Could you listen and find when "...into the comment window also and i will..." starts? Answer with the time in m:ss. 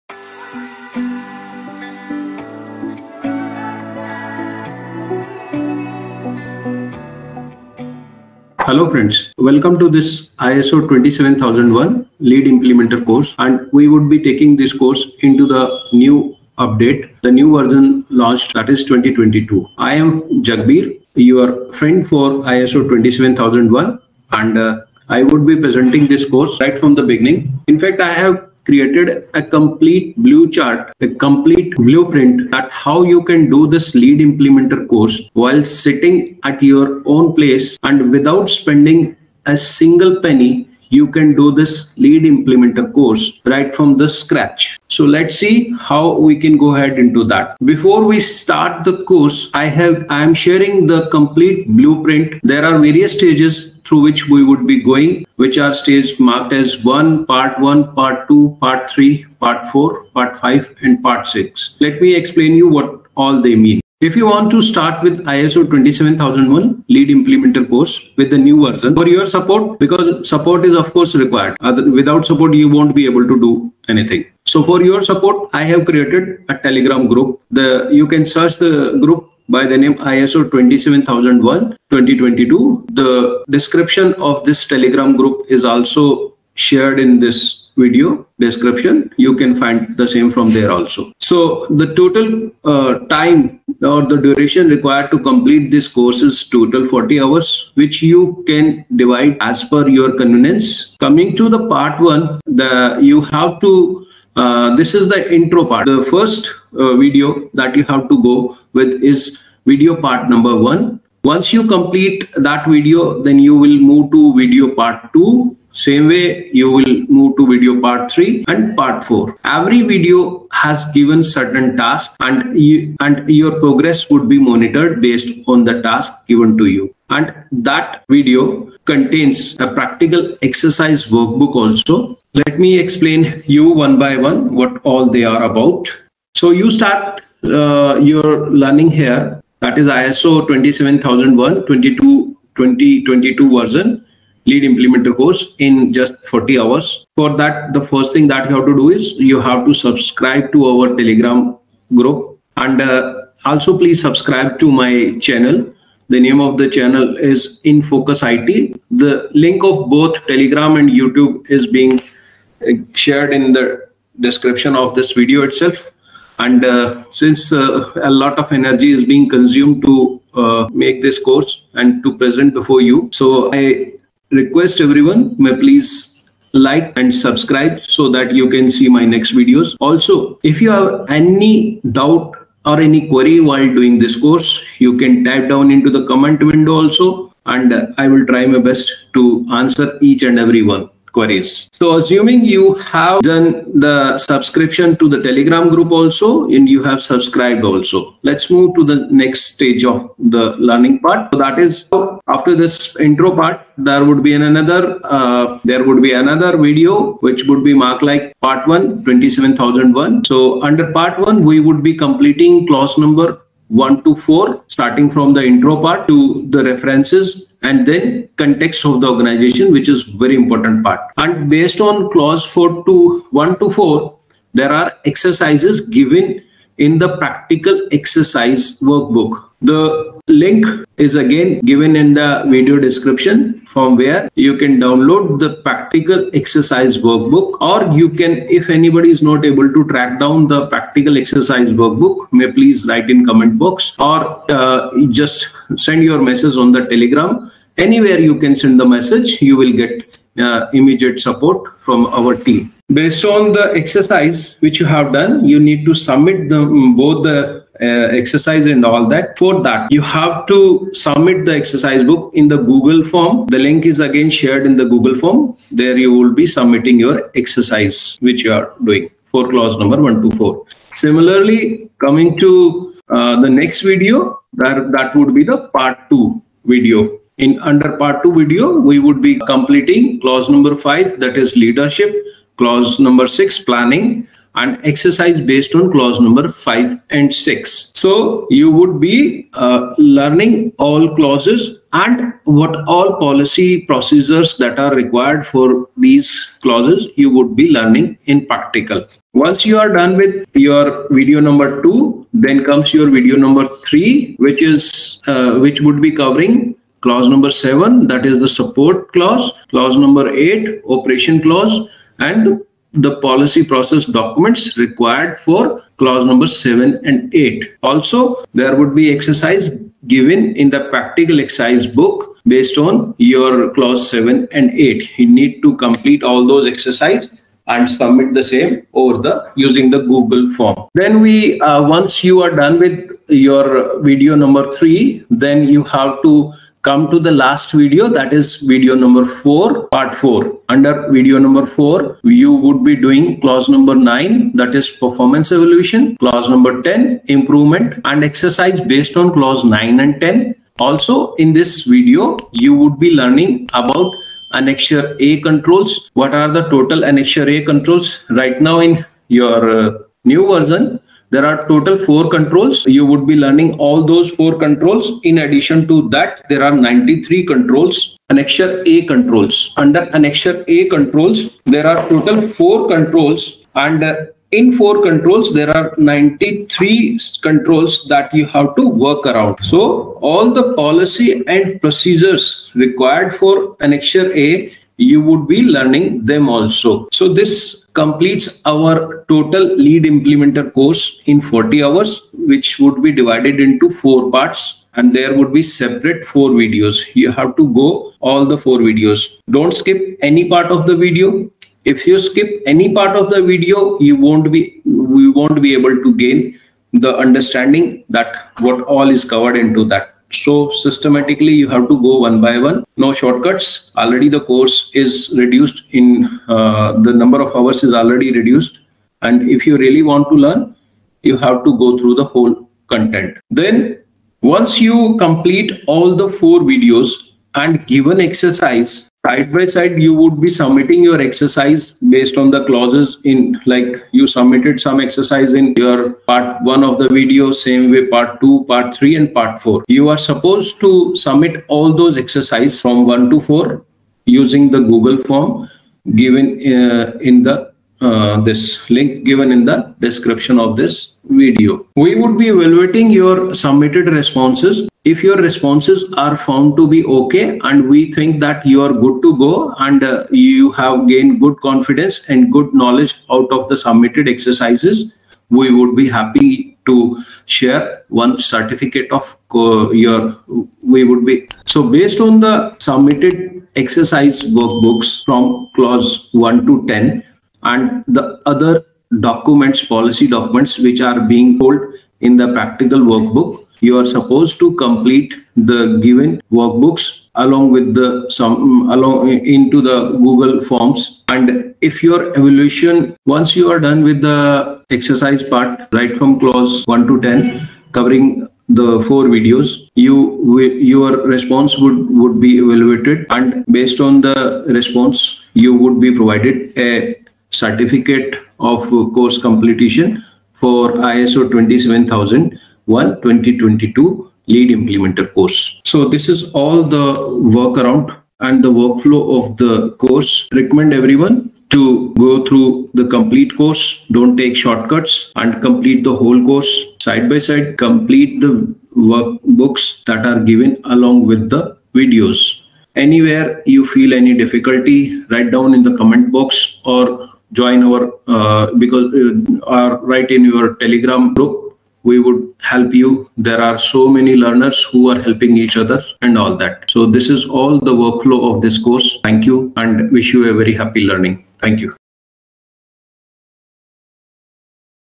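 3:05.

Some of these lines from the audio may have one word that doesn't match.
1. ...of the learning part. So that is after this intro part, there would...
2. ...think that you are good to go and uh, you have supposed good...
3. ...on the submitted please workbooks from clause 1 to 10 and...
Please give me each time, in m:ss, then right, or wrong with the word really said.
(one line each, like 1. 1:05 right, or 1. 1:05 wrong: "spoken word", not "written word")
1. 3:19 right
2. 7:38 wrong: "gained", not "supposed"
3. 7:52 wrong: "exercise", not "please".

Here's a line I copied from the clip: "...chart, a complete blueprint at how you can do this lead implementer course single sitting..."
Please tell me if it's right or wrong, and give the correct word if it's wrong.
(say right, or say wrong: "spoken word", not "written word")
wrong: "while", not "single".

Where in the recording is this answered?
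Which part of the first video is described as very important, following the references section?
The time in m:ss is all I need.
3:38.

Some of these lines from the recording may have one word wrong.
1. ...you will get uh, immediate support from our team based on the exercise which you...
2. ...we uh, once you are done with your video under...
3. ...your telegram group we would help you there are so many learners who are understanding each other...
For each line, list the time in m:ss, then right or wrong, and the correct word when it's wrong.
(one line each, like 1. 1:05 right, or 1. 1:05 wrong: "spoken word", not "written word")
1. 4:09 right
2. 5:31 wrong: "number", not "under"
3. 9:00 wrong: "helping", not "understanding".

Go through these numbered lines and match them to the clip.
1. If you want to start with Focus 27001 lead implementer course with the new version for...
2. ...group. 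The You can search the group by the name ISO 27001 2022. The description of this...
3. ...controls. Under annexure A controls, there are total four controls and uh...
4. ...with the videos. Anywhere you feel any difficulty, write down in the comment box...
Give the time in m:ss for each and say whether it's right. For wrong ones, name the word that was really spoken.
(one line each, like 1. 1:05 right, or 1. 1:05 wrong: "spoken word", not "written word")
1. 1:04 wrong: "ISO", not "Focus"
2. 1:17 right
3. 6:09 right
4. 8:51 right.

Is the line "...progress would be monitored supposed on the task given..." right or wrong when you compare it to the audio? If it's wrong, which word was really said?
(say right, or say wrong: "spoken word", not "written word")
wrong: "based", not "supposed".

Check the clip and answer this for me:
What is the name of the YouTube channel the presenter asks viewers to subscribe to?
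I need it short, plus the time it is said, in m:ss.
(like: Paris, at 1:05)
In Focus IT, at 2:37.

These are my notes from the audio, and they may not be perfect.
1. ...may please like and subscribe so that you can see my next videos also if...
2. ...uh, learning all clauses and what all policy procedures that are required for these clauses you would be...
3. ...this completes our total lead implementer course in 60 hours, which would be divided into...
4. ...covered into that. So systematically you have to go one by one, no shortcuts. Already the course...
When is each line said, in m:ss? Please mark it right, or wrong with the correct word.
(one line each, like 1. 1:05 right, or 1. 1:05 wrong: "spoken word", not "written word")
1. 2:55 right
2. 4:49 right
3. 6:27 wrong: "40", not "60"
4. 6:49 right.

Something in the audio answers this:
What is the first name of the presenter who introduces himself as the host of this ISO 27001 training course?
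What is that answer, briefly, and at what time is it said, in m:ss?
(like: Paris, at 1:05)
Jagbir, at 0:20.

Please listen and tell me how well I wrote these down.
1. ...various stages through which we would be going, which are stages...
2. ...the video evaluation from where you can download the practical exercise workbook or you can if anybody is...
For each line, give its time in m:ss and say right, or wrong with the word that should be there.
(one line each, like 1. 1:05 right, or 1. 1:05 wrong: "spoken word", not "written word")
1. 0:52 right
2. 3:52 wrong: "description", not "evaluation".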